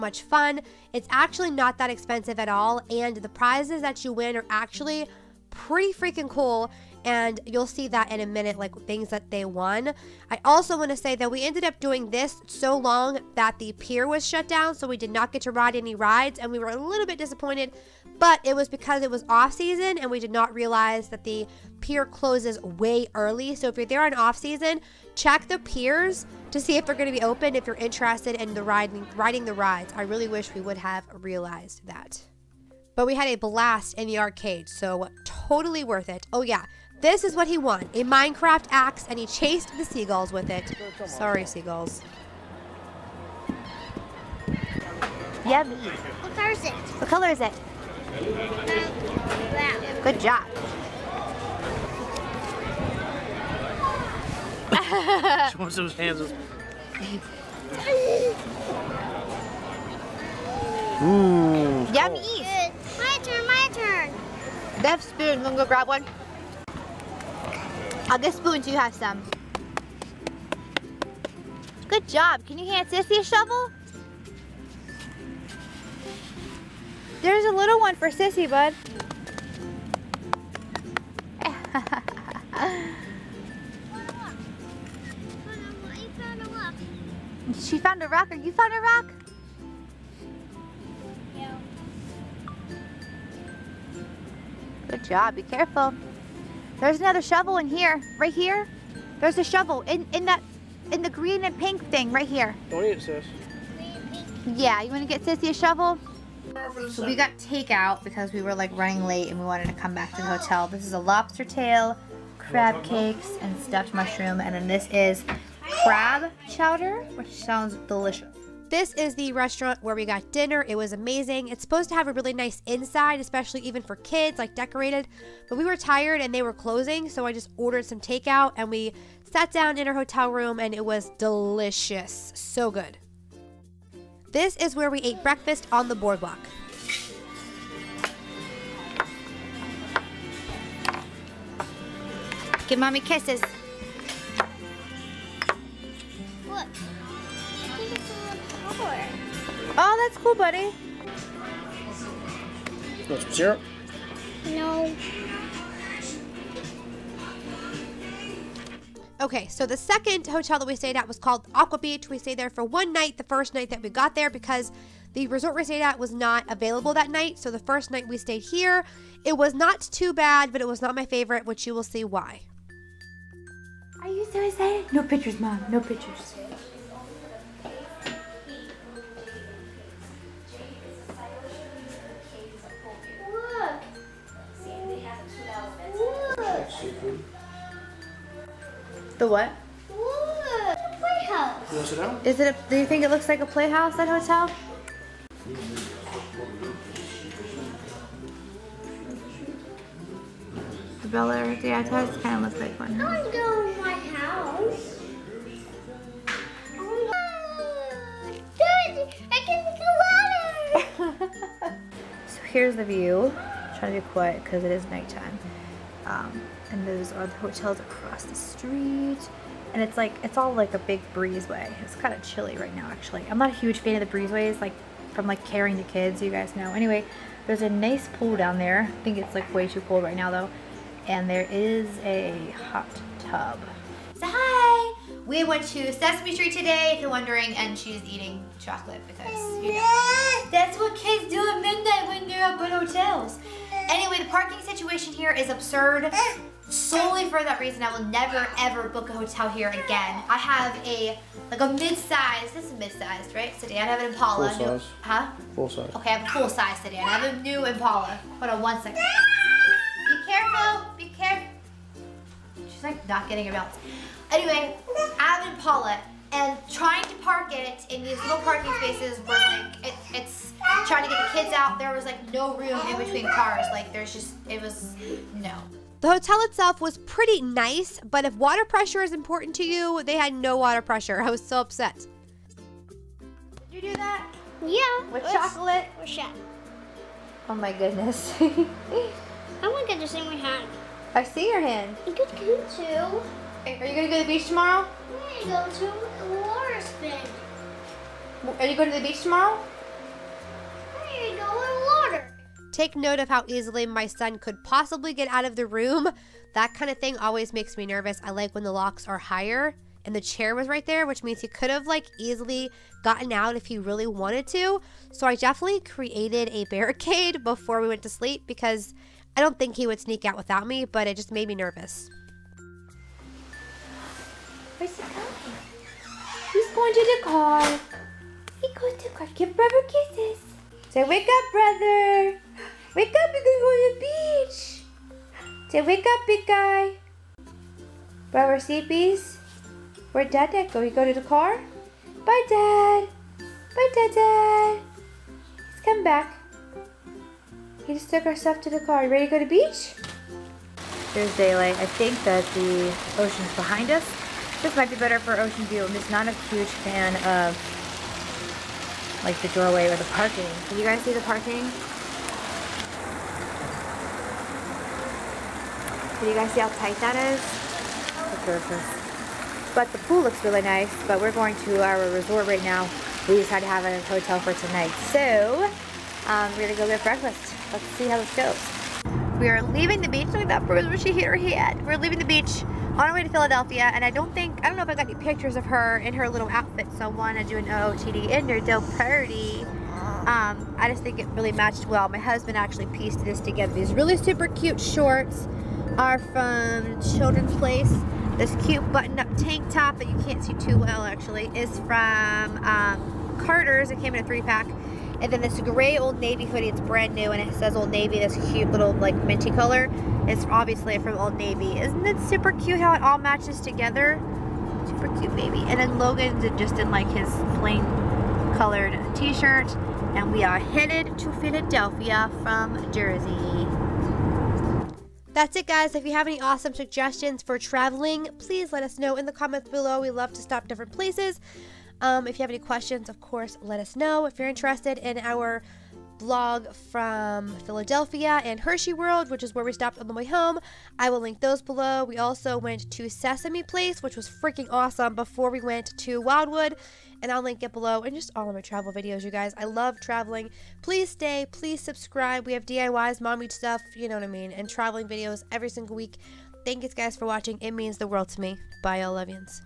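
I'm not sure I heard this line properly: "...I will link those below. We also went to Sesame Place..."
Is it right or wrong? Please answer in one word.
right.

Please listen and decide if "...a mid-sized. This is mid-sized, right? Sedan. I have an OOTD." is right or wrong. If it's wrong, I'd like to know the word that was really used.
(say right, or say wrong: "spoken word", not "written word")
wrong: "Impala", not "OOTD".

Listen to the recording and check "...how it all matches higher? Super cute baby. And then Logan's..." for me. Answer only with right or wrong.
wrong.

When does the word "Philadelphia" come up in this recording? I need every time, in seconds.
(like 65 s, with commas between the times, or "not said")
383 s, 421 s, 437 s.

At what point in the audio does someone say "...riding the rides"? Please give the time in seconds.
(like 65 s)
29 s.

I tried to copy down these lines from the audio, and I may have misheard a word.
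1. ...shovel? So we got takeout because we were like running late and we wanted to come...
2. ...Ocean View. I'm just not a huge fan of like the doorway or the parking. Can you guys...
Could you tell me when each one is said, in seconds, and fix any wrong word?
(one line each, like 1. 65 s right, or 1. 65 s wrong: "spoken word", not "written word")
1. 105 s right
2. 355 s right.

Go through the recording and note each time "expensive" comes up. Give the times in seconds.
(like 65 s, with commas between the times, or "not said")
1 s.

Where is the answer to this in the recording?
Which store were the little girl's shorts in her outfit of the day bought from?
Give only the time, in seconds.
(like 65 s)
397 s.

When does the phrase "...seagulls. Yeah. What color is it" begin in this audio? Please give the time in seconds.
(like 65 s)
41 s.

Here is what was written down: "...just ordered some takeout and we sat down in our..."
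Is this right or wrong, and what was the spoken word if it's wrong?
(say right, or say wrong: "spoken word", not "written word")
right.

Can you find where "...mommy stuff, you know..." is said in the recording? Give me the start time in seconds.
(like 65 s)
453 s.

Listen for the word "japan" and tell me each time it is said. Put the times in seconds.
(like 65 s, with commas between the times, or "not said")
not said.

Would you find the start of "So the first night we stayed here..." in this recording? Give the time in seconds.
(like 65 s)
167 s.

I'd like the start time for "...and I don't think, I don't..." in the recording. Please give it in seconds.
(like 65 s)
383 s.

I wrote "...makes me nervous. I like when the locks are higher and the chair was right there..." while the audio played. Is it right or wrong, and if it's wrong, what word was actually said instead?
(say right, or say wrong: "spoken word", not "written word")
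right.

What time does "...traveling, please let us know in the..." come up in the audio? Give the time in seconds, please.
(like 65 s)
427 s.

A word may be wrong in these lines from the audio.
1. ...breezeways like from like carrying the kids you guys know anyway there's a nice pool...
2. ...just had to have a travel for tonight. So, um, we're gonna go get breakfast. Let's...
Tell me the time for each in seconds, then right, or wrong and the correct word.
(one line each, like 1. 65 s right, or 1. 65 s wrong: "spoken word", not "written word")
1. 224 s right
2. 373 s wrong: "hotel", not "travel".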